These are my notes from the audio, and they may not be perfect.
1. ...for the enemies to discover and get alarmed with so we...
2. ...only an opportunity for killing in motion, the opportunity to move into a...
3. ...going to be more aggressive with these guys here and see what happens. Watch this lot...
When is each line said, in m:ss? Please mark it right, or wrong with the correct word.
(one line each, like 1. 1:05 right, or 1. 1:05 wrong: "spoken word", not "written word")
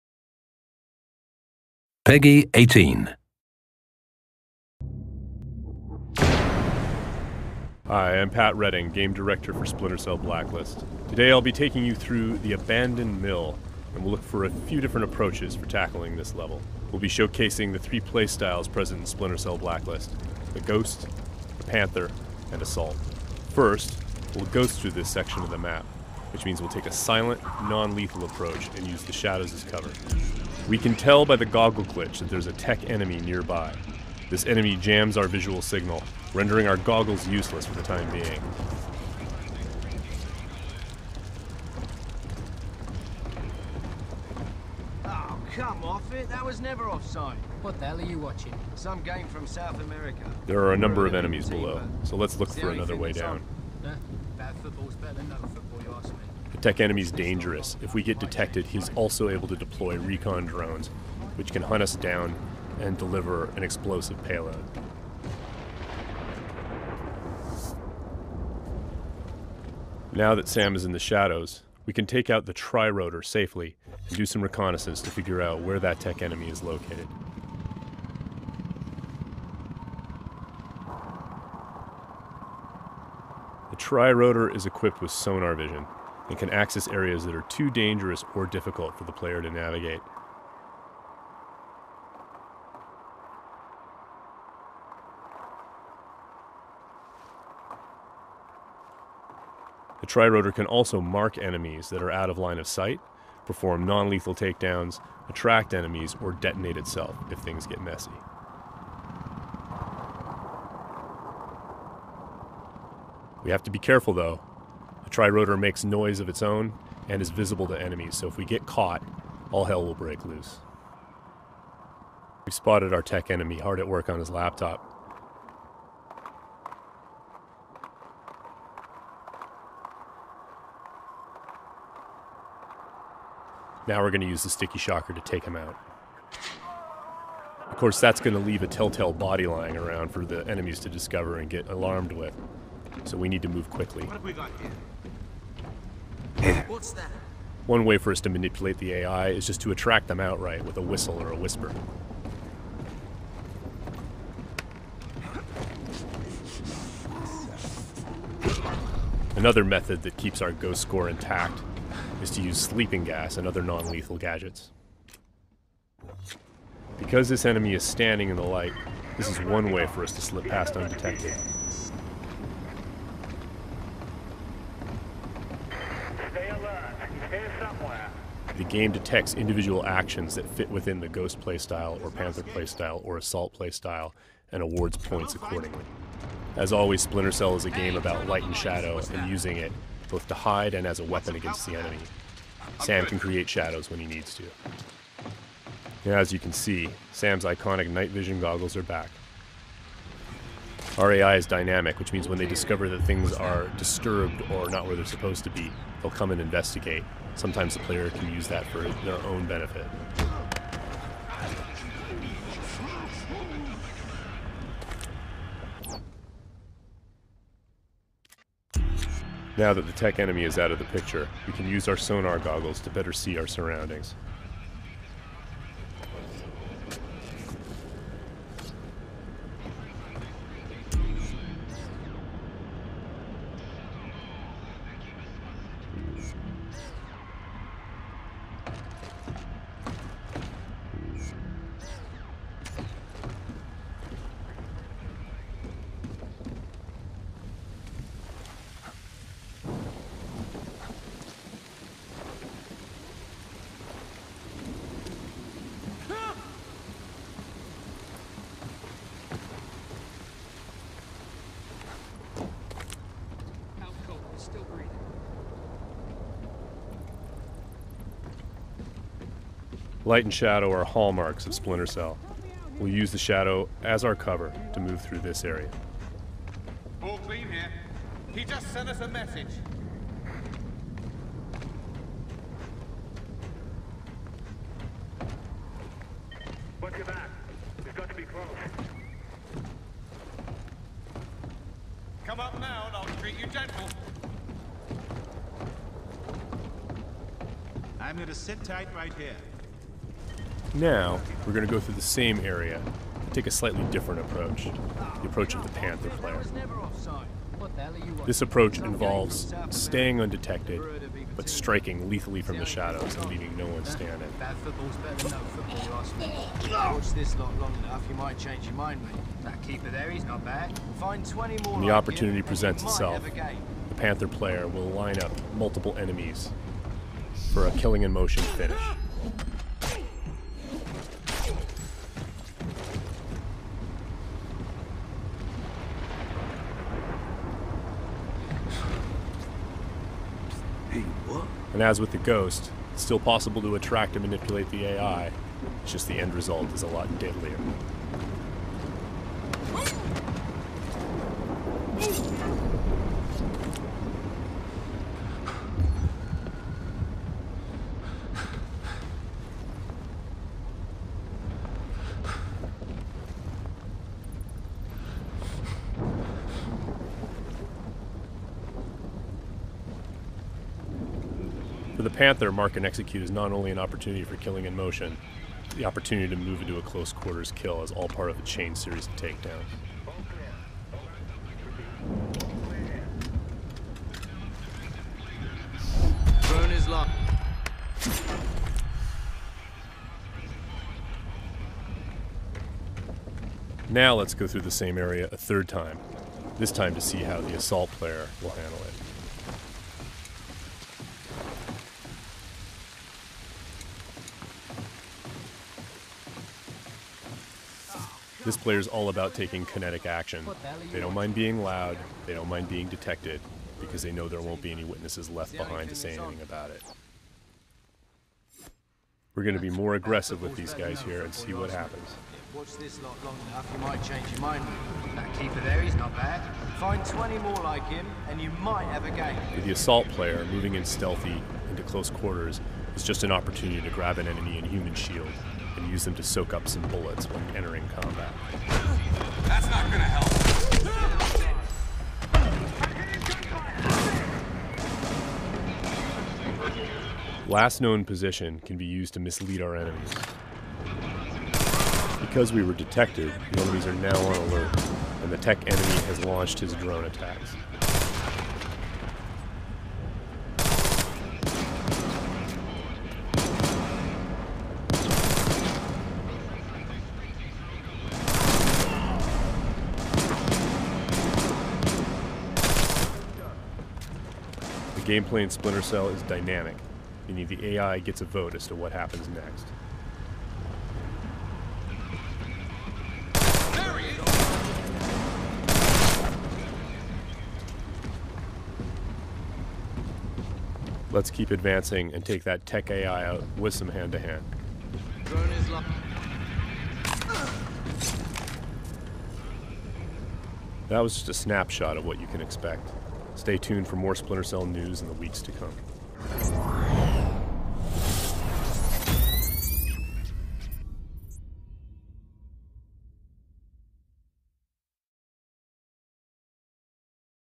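1. 2:20 right
2. 6:13 right
3. 6:59 right.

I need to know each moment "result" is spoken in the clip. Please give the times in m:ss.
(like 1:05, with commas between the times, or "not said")
5:46.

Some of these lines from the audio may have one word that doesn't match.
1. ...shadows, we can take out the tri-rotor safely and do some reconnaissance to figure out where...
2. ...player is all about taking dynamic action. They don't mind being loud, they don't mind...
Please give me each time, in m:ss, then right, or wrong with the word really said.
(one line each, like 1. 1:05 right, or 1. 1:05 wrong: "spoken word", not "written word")
1. 1:10 right
2. 6:48 wrong: "kinetic", not "dynamic".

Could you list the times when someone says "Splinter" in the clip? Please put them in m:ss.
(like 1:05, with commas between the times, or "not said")
0:09, 0:19, 3:07, 4:31, 7:55, 8:24.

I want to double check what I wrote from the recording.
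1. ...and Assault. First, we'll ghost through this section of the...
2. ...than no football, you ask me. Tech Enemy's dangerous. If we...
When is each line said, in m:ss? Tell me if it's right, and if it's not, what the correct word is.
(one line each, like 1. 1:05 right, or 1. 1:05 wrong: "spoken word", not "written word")
1. 0:22 right
2. 0:55 right.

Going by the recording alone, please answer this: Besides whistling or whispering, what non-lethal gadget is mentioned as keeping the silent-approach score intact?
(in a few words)
sleeping gas.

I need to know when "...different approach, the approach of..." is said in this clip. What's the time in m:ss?
5:03.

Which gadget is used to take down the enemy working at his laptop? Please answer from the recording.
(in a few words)
sticky shocker.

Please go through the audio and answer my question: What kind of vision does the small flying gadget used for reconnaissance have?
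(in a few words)
sonar vision.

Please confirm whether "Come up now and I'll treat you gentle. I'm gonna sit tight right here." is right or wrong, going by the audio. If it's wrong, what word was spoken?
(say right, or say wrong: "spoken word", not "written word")
right.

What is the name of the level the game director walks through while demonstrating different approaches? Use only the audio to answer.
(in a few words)
Abandoned Mill.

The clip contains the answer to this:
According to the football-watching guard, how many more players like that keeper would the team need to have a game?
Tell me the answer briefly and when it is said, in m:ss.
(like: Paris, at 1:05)
20, at 7:07.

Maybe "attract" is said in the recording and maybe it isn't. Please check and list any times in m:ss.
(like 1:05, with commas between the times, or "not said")
1:45, 2:29, 5:43.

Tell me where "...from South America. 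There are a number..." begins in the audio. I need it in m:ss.
0:49.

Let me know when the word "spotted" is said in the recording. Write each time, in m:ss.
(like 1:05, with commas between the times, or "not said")
2:02.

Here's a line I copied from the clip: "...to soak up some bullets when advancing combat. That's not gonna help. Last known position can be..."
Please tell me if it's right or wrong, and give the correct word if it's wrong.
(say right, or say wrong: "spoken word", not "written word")
wrong: "entering", not "advancing".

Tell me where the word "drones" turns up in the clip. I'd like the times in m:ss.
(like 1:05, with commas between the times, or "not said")
1:00, 7:36.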